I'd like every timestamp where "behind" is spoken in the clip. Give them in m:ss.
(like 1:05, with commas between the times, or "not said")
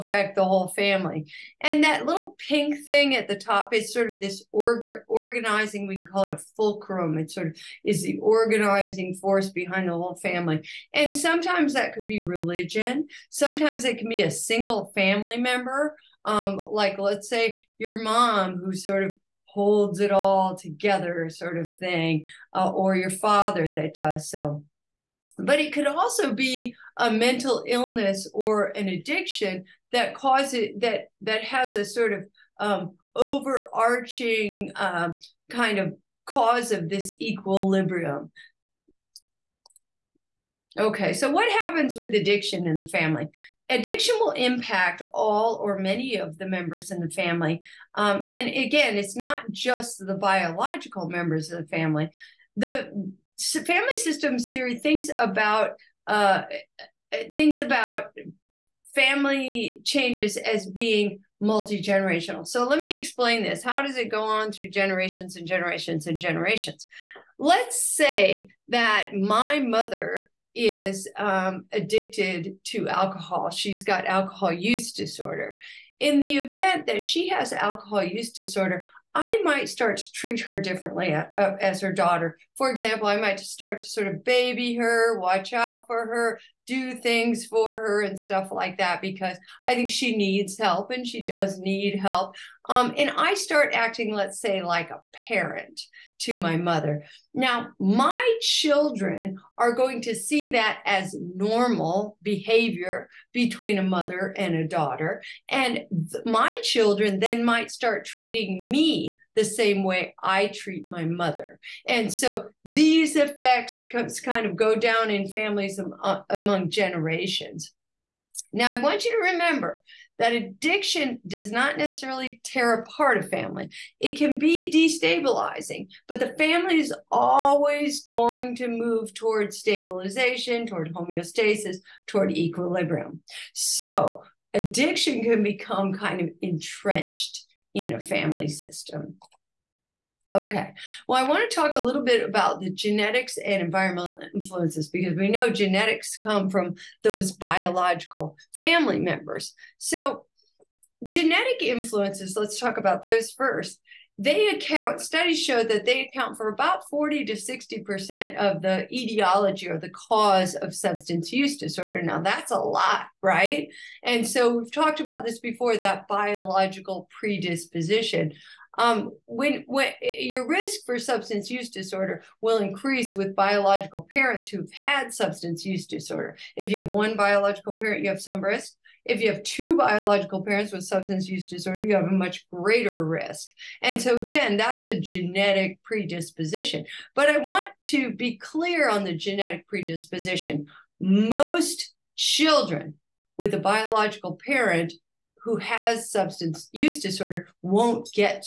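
0:09.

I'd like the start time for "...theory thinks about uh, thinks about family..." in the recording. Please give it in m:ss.
0:54.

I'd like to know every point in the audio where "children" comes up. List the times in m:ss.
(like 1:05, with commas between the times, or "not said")
1:38, 1:46, 3:12.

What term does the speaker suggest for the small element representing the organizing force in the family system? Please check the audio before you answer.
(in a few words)
fulcrum.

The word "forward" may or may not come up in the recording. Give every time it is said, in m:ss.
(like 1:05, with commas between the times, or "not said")
not said.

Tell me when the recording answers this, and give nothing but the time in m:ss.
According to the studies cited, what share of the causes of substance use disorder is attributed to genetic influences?
2:36.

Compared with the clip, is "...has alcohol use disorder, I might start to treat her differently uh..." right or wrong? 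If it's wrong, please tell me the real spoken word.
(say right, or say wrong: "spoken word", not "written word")
right.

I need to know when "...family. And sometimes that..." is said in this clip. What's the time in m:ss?
0:10.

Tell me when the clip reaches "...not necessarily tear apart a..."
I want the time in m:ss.
2:01.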